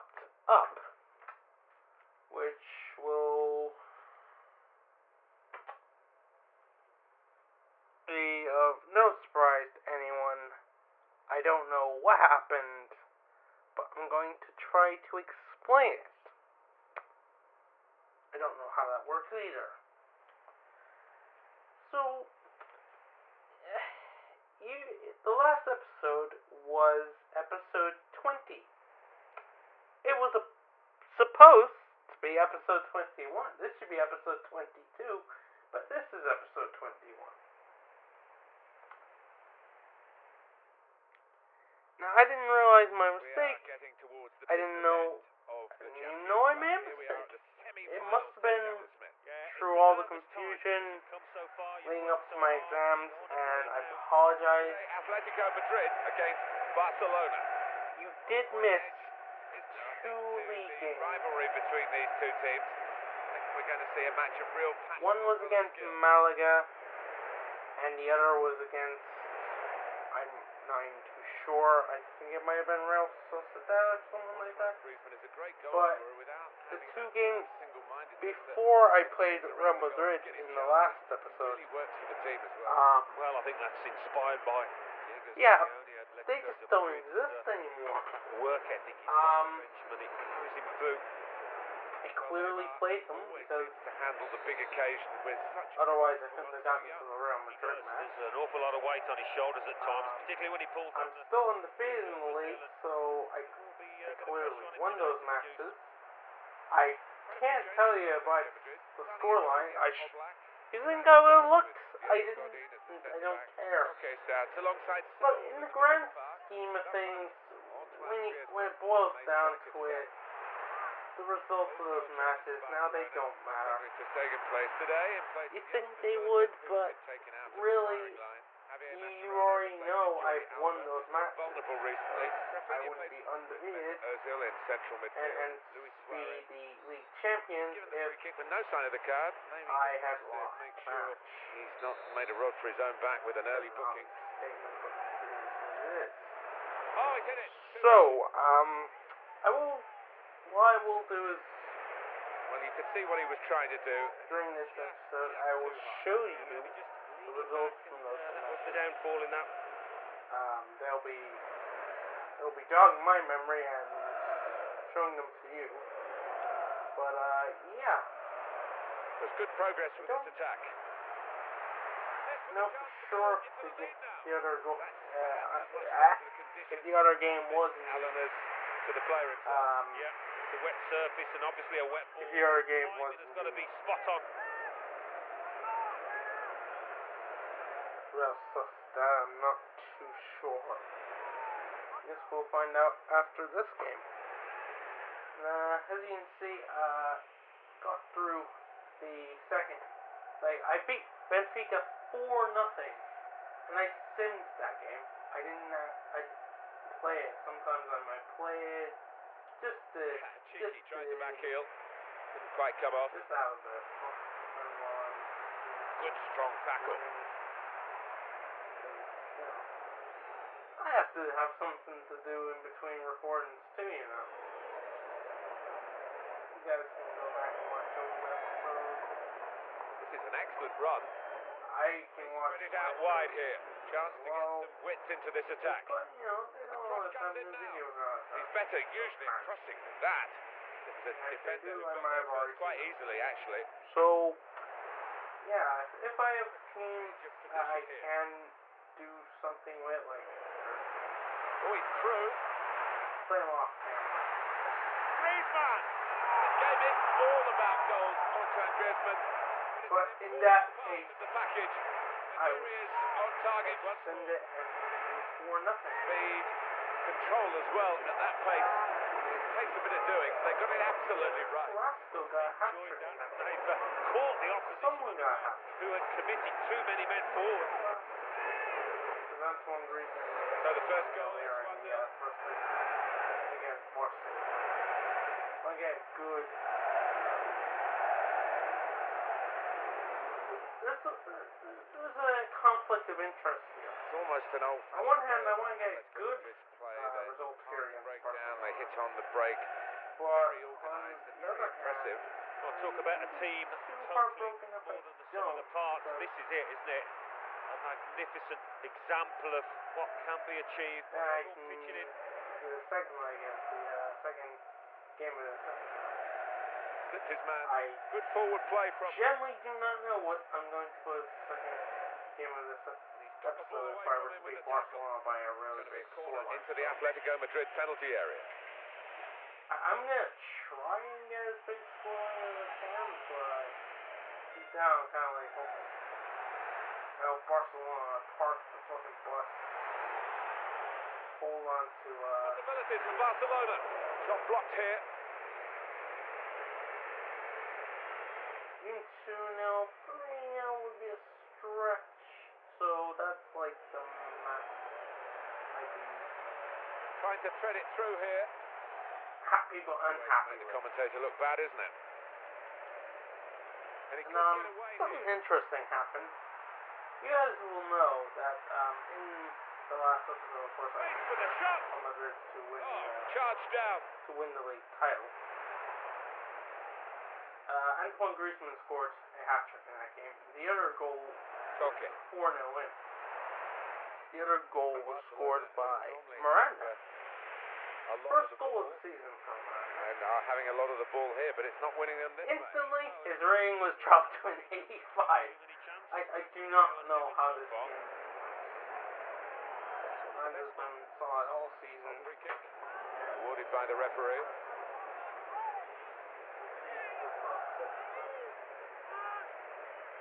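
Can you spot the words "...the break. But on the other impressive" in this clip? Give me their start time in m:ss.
4:59.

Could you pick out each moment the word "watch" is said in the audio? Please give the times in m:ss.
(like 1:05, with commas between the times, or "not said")
3:47, 3:52.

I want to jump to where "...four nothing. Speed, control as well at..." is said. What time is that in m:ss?
4:25.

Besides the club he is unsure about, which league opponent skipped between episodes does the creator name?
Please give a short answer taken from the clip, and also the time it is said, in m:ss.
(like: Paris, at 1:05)
Malaga, at 1:05.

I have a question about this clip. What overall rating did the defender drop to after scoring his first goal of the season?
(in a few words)
85.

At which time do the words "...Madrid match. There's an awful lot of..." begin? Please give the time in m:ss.
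1:37.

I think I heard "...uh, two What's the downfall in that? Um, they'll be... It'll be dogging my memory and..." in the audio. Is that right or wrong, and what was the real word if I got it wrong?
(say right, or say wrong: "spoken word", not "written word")
right.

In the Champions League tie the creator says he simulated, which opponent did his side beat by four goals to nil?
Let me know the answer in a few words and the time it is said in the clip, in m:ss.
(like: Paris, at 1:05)
Benfica, at 3:21.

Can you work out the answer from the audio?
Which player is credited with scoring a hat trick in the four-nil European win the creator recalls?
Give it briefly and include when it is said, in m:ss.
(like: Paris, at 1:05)
Carrasco, at 4:31.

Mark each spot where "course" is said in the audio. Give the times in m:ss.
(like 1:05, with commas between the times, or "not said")
6:10.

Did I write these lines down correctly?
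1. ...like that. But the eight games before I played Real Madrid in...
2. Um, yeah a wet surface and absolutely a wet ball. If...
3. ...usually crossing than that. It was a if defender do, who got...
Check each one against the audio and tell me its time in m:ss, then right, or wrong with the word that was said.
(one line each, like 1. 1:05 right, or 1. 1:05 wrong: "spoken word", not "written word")
1. 1:14 wrong: "two", not "eight"
2. 2:59 wrong: "obviously", not "absolutely"
3. 3:58 right.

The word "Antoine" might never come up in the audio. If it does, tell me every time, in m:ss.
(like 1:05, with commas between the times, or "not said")
4:18, 4:39, 6:17.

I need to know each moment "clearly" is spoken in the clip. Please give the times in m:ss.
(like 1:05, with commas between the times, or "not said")
1:32, 1:44.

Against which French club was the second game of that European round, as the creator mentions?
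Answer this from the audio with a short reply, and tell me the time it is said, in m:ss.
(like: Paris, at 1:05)
Marseille, at 4:43.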